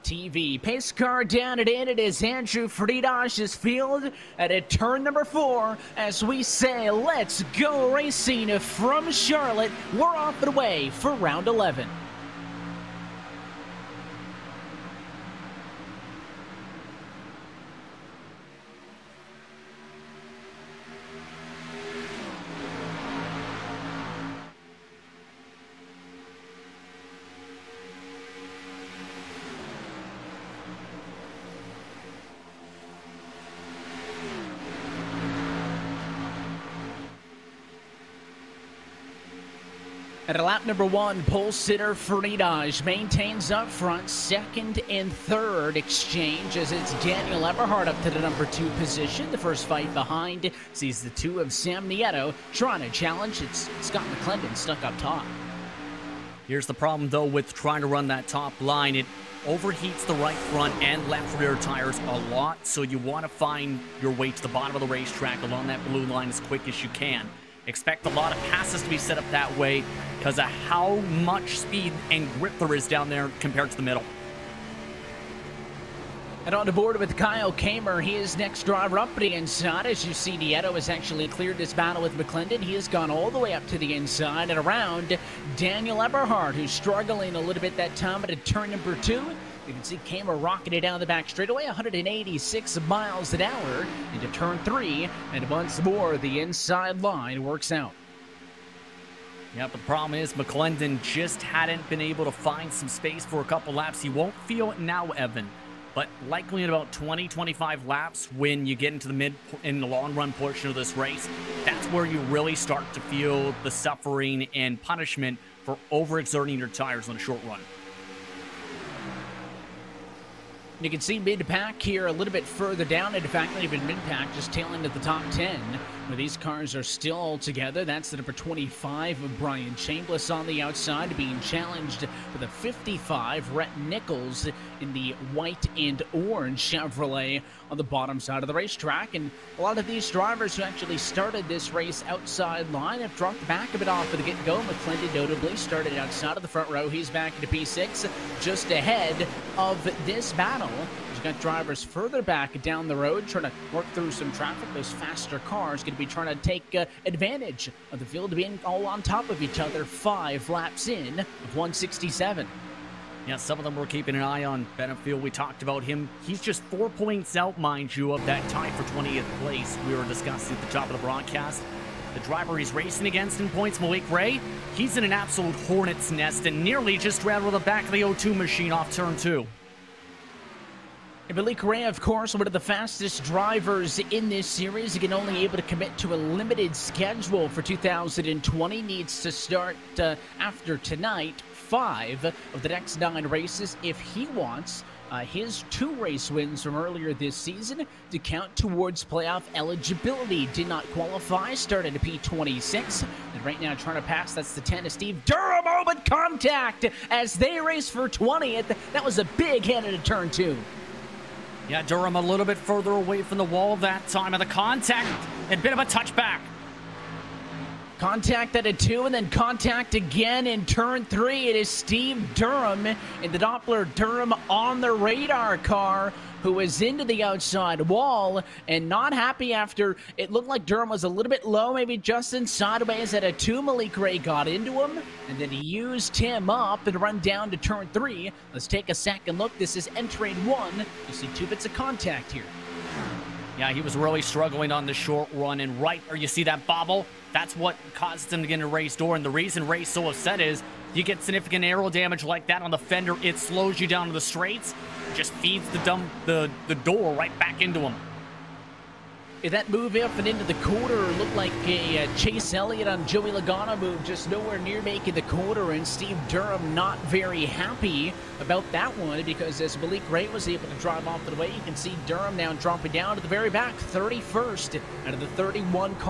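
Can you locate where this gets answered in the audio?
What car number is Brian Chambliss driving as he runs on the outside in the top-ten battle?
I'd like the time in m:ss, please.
2:08.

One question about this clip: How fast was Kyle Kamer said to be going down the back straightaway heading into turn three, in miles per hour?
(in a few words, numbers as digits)
186.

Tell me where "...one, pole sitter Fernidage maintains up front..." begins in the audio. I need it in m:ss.
0:40.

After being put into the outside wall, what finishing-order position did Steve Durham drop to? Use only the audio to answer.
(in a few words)
31st.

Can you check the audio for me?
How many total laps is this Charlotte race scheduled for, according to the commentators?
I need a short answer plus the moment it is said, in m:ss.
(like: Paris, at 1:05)
167, at 2:41.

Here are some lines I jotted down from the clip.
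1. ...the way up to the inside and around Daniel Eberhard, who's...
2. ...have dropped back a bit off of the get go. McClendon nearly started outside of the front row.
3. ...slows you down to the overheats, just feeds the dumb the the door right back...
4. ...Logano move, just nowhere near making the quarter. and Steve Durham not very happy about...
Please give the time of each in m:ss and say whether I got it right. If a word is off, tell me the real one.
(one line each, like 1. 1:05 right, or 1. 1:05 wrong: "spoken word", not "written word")
1. 1:23 right
2. 2:22 wrong: "notably", not "nearly"
3. 4:13 wrong: "straights", not "overheats"
4. 4:23 right.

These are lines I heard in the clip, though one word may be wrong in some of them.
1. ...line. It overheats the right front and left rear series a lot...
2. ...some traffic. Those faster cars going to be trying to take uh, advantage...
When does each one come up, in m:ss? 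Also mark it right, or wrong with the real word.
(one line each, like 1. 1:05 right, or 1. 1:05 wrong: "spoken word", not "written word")
1. 0:58 wrong: "tires", not "series"
2. 2:34 right.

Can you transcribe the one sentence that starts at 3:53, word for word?
Malik Ray got into him, and then he used him up and run down to turn three.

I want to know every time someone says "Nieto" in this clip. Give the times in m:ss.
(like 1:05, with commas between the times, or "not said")
0:51, 1:20.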